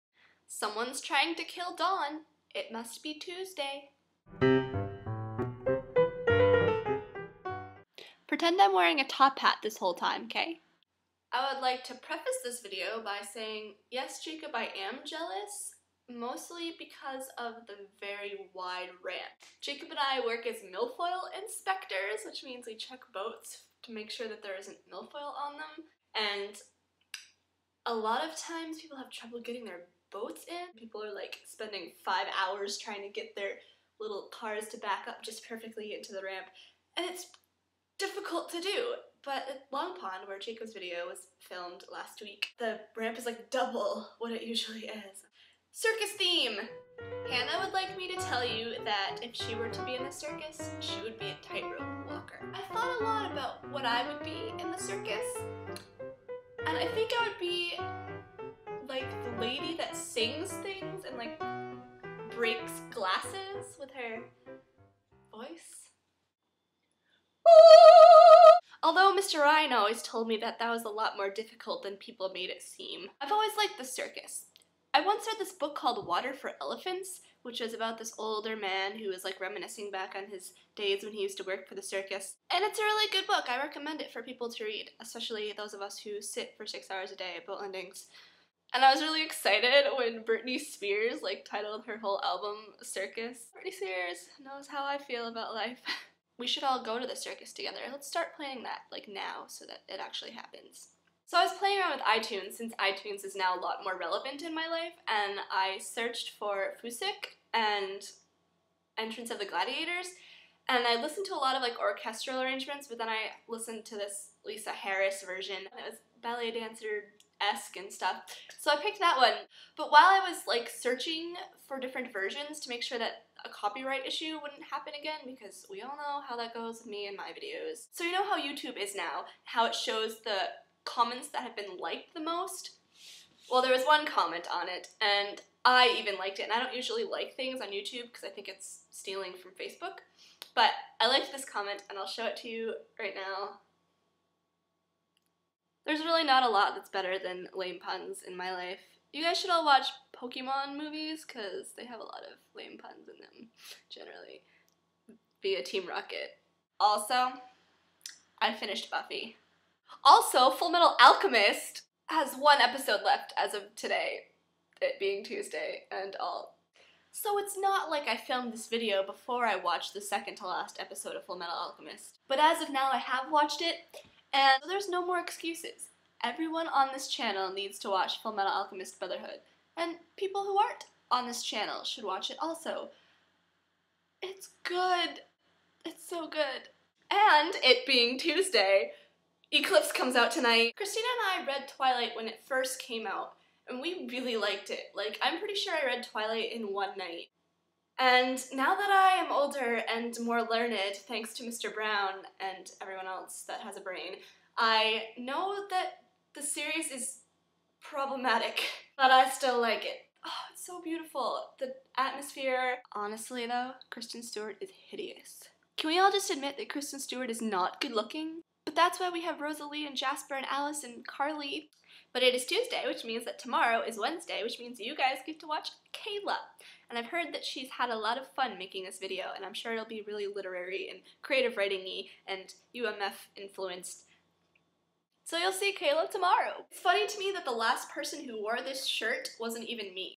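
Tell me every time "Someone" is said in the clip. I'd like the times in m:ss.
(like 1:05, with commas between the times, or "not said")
0:00.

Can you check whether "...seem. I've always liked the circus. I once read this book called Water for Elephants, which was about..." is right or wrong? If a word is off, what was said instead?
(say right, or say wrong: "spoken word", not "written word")
right.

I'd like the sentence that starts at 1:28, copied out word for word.
And I was really excited when Britney Spears like titled her whole album Circus.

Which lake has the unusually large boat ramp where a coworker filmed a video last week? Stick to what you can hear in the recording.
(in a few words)
Long Pond.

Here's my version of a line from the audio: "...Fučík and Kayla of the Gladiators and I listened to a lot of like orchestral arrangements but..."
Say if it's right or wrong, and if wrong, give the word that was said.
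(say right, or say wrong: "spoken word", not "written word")
wrong: "Entrance", not "Kayla".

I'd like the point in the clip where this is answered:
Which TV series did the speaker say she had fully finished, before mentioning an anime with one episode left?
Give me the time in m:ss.
2:38.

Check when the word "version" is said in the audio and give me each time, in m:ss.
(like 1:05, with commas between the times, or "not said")
1:55, 2:02.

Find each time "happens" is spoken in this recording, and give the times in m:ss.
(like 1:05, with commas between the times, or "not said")
1:40, 2:04.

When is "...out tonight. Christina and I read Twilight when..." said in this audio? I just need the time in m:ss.
3:10.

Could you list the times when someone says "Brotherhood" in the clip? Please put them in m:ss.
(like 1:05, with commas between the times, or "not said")
2:58.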